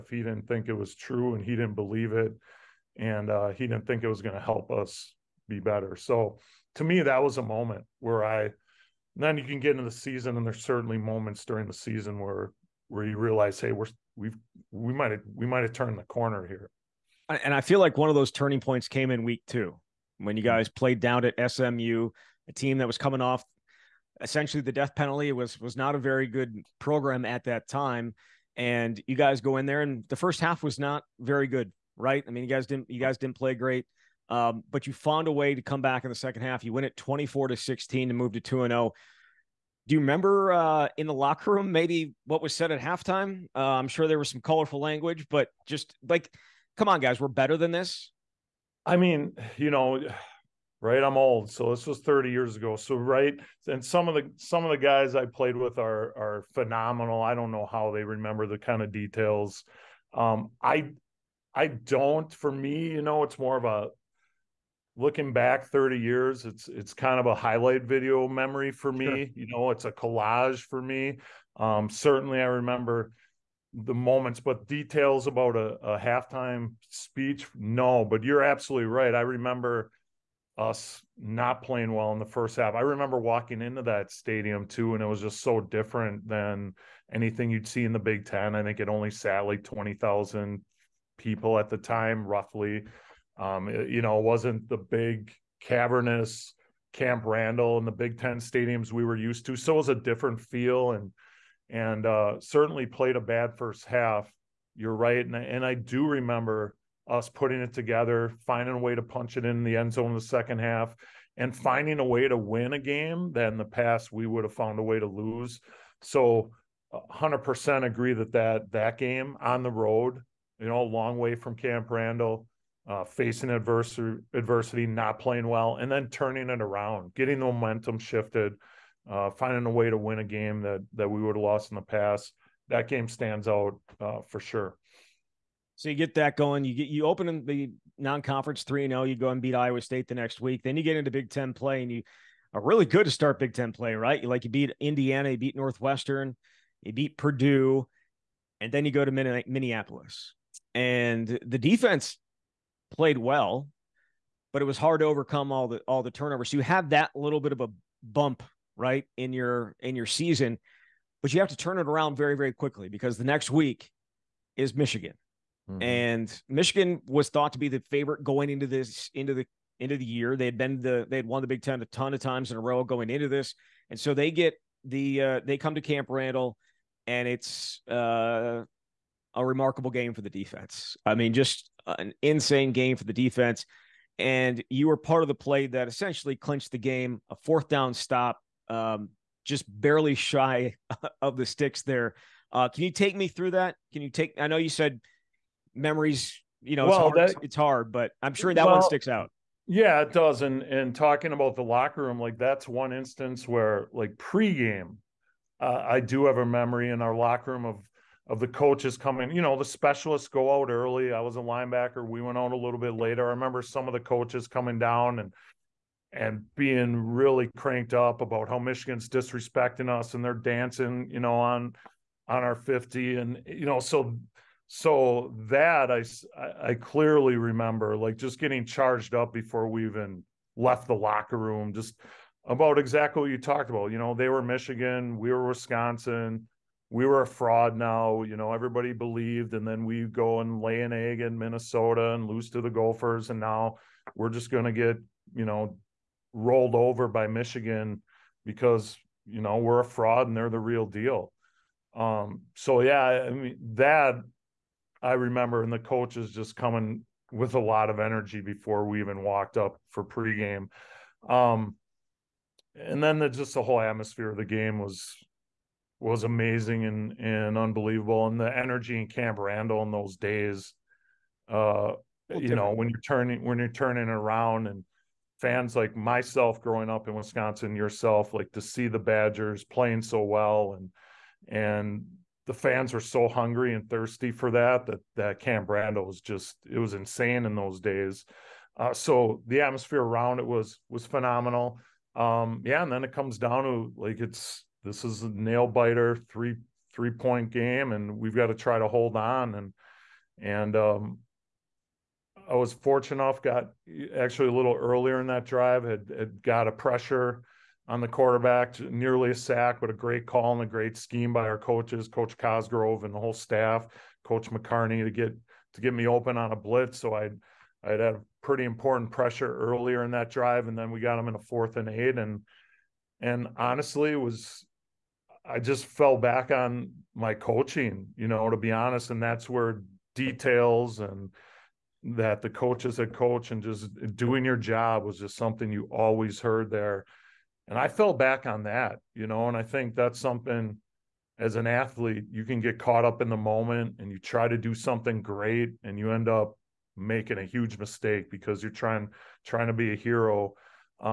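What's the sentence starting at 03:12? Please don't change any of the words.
Uh, can you take me through that?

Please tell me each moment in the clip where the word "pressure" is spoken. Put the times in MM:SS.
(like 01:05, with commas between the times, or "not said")
05:06, 05:19.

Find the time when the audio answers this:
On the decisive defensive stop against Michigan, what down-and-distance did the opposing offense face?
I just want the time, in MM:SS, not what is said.
05:21.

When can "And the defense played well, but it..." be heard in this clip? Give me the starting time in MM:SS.
02:30.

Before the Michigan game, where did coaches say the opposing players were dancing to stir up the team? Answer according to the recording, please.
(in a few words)
On the 50.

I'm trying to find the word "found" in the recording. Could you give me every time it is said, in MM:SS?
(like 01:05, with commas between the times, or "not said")
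00:34, 01:54.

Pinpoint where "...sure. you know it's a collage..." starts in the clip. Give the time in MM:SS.
01:09.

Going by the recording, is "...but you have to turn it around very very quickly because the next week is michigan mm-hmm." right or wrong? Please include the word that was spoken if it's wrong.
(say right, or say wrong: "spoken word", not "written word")
right.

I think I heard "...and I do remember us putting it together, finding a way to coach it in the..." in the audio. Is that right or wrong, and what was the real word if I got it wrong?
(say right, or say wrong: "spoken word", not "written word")
wrong: "punch", not "coach".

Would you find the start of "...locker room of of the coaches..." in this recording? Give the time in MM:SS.
03:27.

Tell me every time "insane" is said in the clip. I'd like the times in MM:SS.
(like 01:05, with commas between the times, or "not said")
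03:02, 04:46.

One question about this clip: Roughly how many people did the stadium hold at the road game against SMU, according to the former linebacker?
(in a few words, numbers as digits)
20,000.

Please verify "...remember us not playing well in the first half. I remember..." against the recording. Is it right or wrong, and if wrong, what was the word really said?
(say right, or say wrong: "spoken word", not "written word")
right.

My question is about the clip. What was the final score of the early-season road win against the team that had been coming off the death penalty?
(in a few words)
24-16.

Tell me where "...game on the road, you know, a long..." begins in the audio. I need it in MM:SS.
01:58.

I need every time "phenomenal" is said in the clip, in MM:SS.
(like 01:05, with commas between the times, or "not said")
00:56, 04:51.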